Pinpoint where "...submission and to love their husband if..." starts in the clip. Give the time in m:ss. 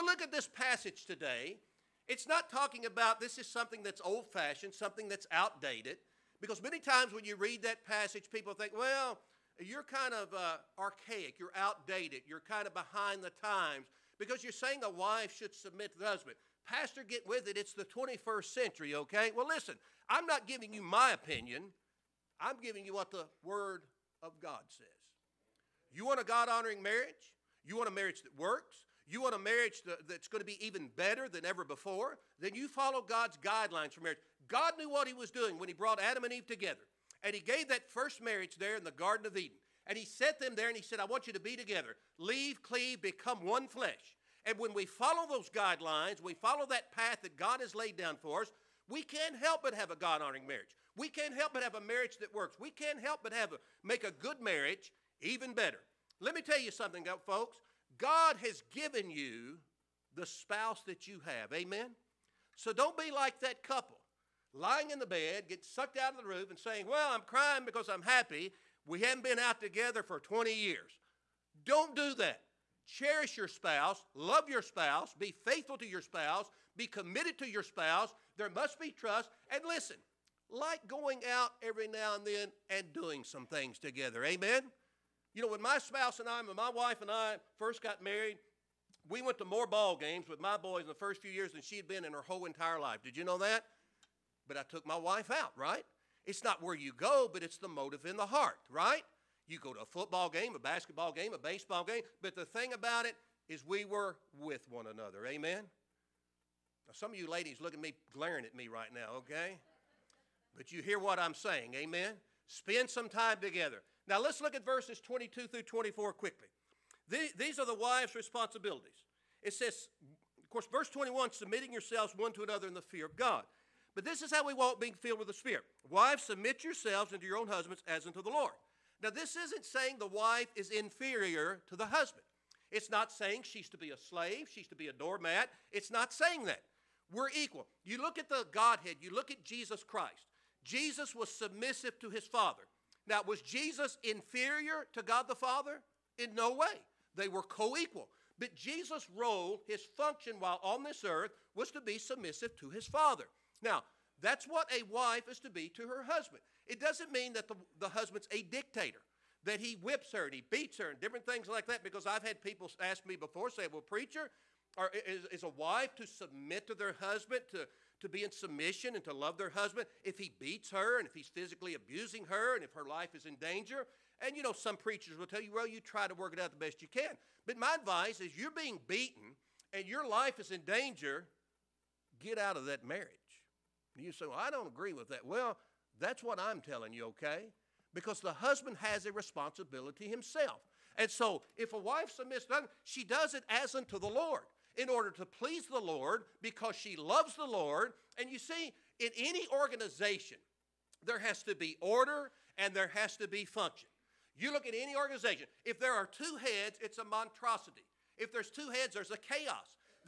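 2:48.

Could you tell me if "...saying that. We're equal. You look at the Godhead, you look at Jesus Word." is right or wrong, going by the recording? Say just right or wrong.
wrong.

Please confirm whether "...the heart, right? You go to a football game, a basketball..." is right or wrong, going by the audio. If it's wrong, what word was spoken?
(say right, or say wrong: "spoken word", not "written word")
right.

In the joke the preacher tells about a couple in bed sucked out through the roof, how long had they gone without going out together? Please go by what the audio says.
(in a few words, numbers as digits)
20 years.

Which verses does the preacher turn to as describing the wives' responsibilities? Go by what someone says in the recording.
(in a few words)
22 through 24.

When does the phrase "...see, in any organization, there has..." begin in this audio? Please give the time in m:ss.
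3:18.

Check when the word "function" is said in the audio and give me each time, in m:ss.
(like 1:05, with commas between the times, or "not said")
2:29, 3:23.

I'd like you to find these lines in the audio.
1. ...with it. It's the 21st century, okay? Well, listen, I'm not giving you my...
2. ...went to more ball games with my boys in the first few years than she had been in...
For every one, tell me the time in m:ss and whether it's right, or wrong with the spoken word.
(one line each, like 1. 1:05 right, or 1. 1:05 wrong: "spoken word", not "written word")
1. 0:17 right
2. 1:29 right.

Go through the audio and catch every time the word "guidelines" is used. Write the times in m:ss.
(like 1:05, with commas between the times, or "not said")
0:33, 0:45.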